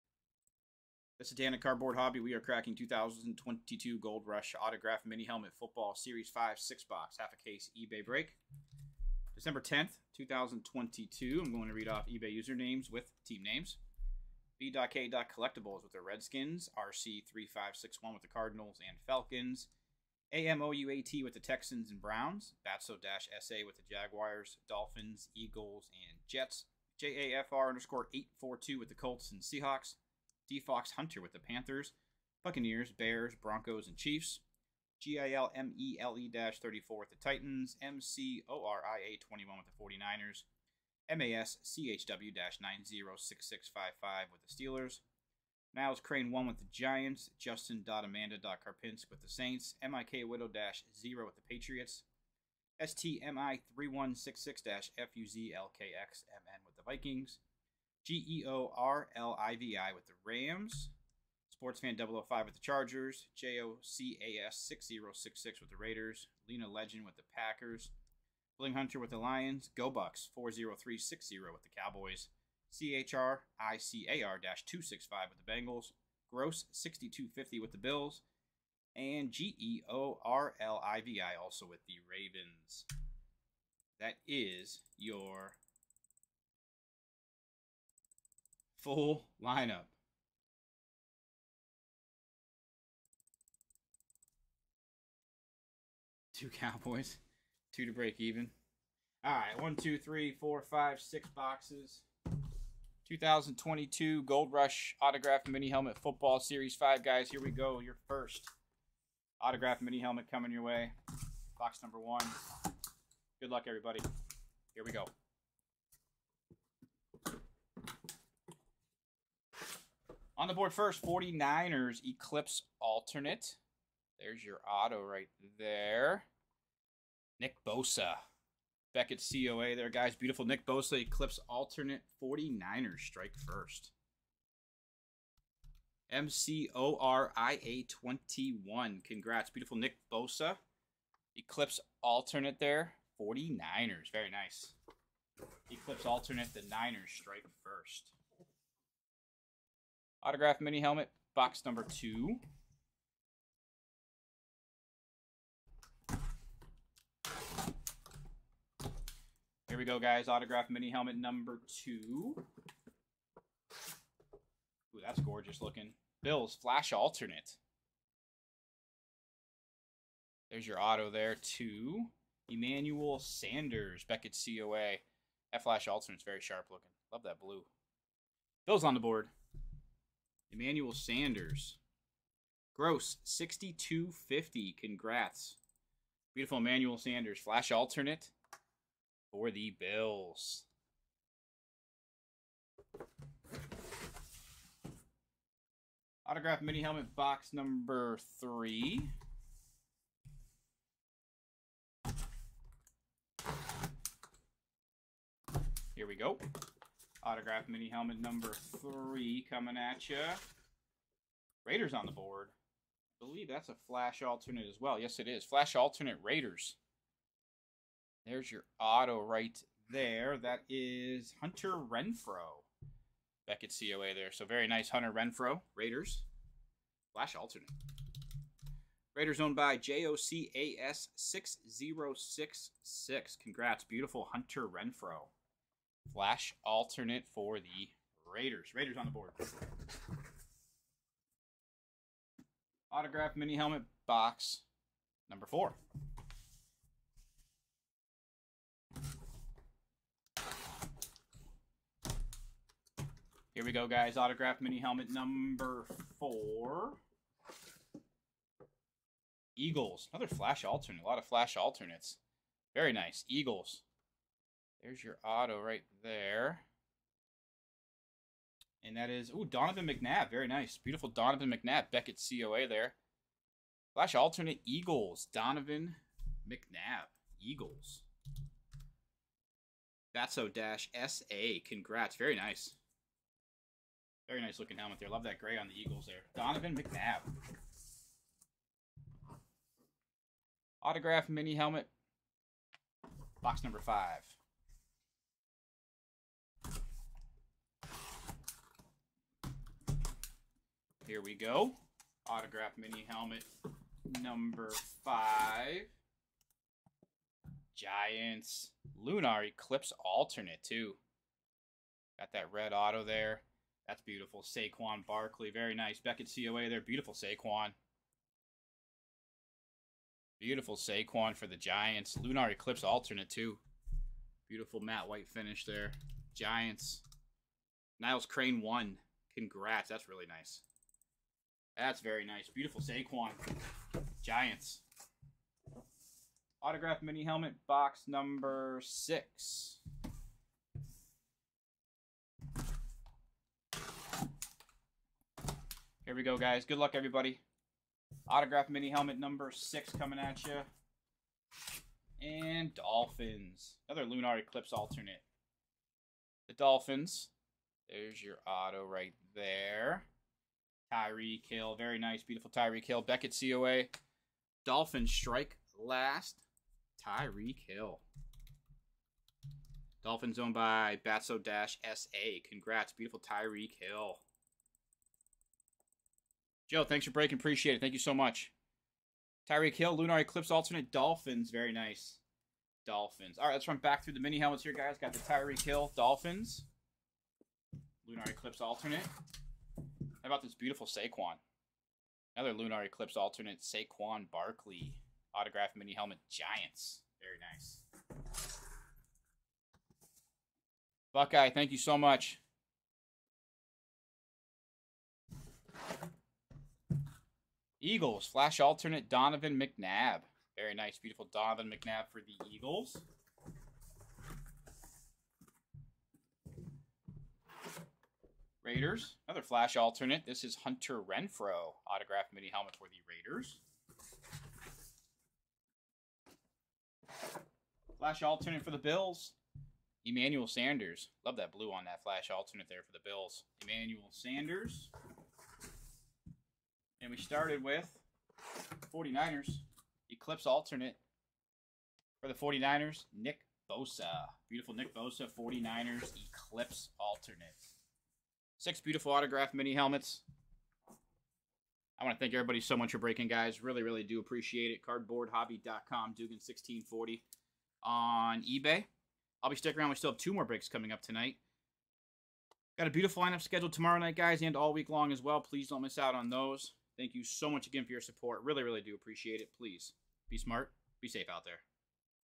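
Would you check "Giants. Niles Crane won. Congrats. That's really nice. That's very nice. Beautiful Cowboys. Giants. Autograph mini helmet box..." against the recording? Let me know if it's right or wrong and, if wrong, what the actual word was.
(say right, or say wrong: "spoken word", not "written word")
wrong: "Saquon", not "Cowboys".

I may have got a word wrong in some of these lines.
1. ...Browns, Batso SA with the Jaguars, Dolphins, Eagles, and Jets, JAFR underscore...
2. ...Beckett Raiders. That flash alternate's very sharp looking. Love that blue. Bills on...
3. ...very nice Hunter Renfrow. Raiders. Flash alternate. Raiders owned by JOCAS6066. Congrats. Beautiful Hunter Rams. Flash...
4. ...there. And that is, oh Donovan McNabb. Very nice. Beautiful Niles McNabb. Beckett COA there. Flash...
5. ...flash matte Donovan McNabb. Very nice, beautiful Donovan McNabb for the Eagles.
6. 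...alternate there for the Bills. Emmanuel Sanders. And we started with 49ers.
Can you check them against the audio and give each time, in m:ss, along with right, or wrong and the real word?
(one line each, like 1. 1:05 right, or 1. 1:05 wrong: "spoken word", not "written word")
1. 0:22 right
2. 2:54 wrong: "COA", not "Raiders"
3. 3:44 wrong: "Renfrow", not "Rams"
4. 4:26 wrong: "Donovan", not "Niles"
5. 6:48 wrong: "alternate", not "matte"
6. 7:12 right.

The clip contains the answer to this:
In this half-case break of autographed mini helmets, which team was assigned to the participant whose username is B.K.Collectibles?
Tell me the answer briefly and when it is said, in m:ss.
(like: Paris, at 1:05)
Redskins, at 0:16.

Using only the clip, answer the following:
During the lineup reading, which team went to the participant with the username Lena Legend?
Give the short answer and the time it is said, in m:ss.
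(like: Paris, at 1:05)
Packers, at 1:07.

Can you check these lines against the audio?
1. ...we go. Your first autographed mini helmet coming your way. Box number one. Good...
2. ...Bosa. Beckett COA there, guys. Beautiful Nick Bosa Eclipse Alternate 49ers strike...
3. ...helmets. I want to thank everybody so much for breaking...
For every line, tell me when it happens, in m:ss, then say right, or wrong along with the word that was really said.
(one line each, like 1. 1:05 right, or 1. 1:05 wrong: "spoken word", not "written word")
1. 1:47 right
2. 2:07 right
3. 7:29 right.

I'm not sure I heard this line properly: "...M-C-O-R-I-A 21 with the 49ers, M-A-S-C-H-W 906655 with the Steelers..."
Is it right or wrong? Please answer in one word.
right.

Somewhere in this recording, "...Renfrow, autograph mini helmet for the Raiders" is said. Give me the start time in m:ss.
7:01.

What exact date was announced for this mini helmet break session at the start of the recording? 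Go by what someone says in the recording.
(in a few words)
December 10th, 2022.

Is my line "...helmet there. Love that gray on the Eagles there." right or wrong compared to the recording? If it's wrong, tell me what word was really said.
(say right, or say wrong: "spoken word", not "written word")
right.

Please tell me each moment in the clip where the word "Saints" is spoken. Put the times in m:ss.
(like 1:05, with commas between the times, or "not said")
0:49.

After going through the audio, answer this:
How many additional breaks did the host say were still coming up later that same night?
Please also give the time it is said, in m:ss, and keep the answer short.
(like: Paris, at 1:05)
2, at 7:40.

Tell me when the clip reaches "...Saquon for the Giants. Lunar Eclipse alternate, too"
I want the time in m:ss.
5:20.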